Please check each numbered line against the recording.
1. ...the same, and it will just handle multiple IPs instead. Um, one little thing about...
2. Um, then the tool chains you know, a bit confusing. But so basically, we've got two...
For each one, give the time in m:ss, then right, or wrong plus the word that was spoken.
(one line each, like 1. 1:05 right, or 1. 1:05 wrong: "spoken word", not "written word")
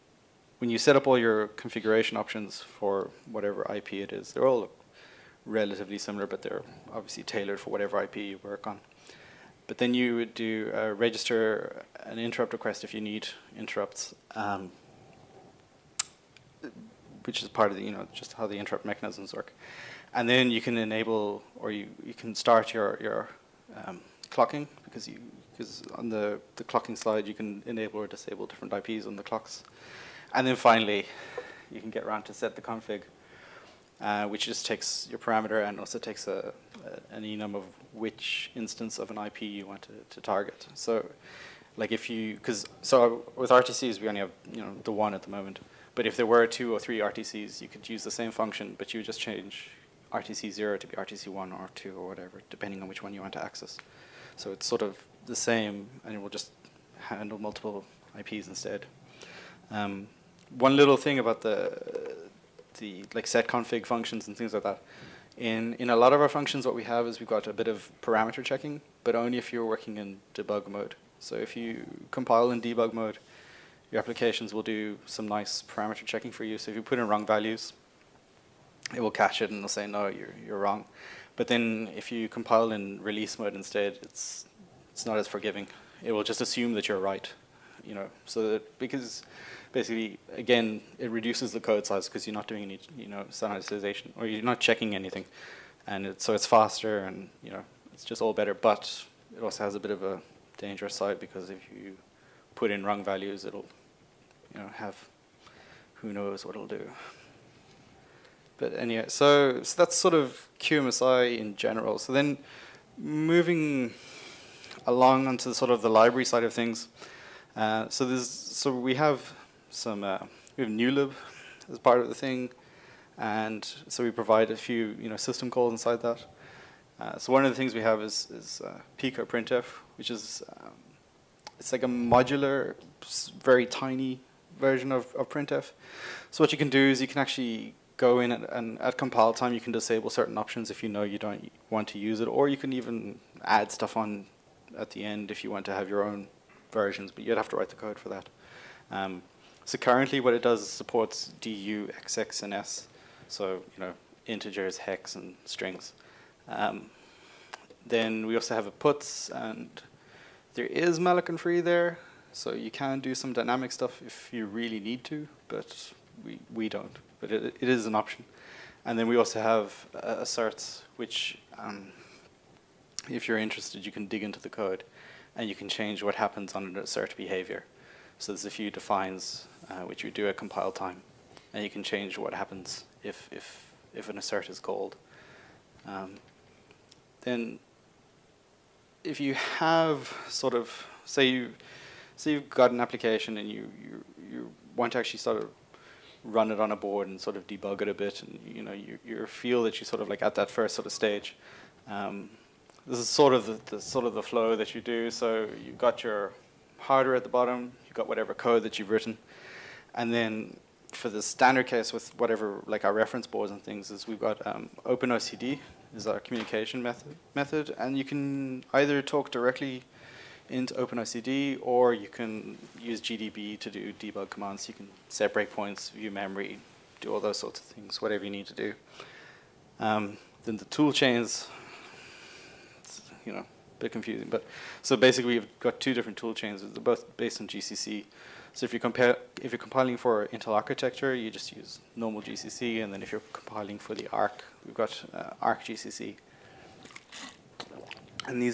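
1. 0:55 right
2. 3:49 right.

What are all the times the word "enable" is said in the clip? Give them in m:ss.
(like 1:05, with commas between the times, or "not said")
0:20, 0:27.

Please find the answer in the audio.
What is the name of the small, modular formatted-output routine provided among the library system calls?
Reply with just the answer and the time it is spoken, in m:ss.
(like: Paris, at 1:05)
Pico printf, at 2:08.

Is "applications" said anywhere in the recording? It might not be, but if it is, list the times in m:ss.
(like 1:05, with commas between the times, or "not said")
1:13, 3:12.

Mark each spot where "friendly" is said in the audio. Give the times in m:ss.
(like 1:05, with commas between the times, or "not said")
not said.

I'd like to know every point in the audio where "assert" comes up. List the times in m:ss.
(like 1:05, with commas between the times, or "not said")
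2:50, 2:56, 3:04.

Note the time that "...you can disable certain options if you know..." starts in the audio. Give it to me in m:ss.
2:19.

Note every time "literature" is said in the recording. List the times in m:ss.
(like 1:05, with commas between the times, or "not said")
not said.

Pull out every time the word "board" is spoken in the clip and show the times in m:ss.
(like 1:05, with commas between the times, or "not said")
3:16, 3:33.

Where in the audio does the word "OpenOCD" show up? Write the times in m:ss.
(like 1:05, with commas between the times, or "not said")
3:34, 3:40.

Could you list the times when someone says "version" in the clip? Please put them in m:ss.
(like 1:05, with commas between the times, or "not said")
2:14, 2:26.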